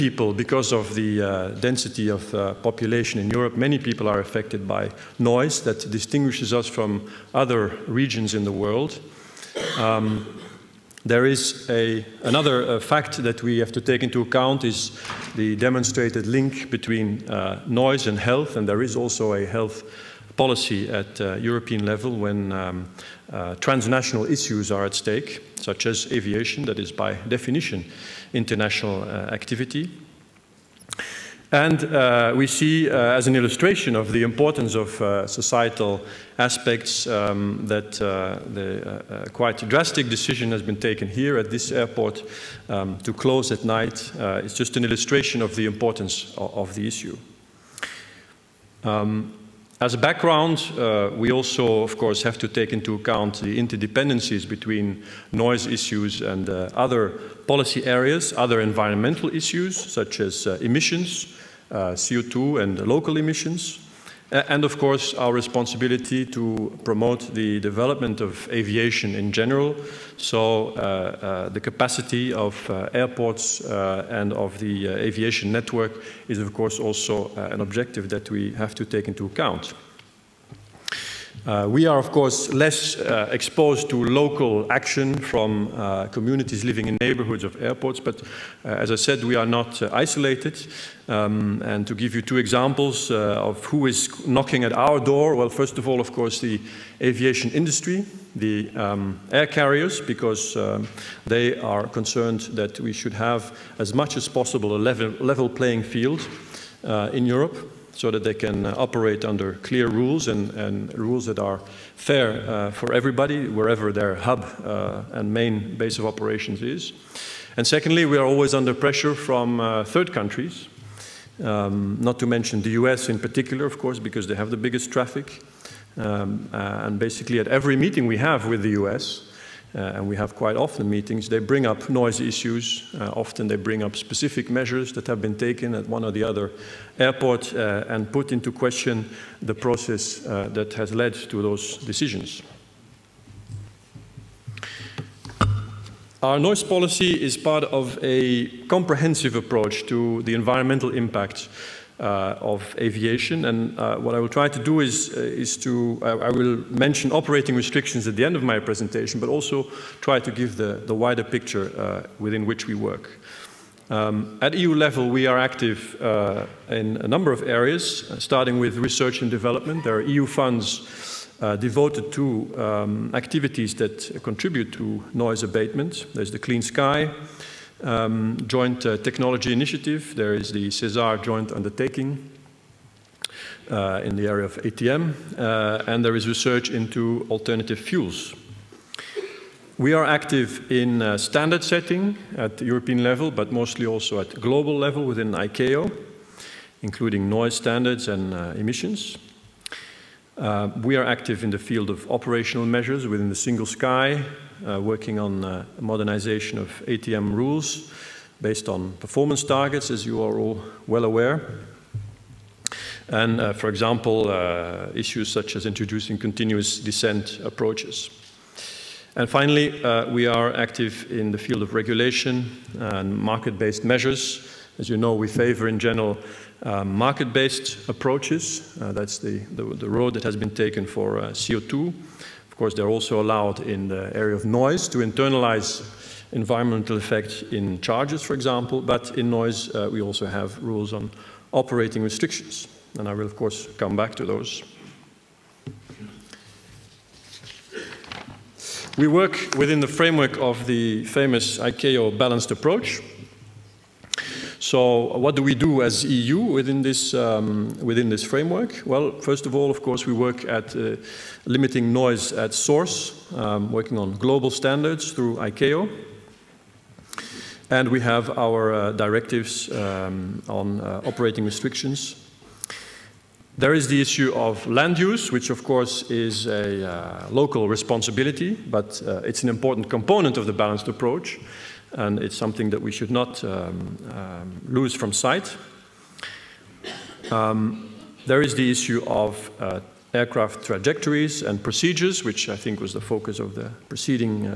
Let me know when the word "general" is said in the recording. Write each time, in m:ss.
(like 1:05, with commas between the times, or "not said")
1:09, 3:45.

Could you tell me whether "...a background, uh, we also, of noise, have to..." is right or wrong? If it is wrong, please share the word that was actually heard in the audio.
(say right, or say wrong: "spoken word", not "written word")
wrong: "course", not "noise".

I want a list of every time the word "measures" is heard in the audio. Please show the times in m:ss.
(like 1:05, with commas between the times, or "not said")
2:14, 3:22, 3:43.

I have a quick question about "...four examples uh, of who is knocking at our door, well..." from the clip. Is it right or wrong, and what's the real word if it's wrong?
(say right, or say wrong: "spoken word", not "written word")
wrong: "two", not "four".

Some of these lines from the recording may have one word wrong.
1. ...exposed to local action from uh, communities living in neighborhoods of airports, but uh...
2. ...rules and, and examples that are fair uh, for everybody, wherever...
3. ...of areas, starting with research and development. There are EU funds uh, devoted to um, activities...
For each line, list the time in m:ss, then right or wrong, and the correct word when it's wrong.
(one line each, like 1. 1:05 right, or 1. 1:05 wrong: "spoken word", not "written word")
1. 1:23 right
2. 1:49 wrong: "rules", not "examples"
3. 2:47 right.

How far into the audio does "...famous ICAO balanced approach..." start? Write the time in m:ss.
4:11.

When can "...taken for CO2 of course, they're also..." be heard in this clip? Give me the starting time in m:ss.
3:50.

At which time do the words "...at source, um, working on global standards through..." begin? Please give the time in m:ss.
4:22.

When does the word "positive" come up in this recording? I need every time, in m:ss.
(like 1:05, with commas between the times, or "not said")
not said.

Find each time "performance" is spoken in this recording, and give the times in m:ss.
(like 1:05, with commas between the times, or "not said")
3:29.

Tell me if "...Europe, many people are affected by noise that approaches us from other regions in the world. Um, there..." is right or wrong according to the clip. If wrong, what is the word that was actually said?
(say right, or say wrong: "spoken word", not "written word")
wrong: "distinguishes", not "approaches".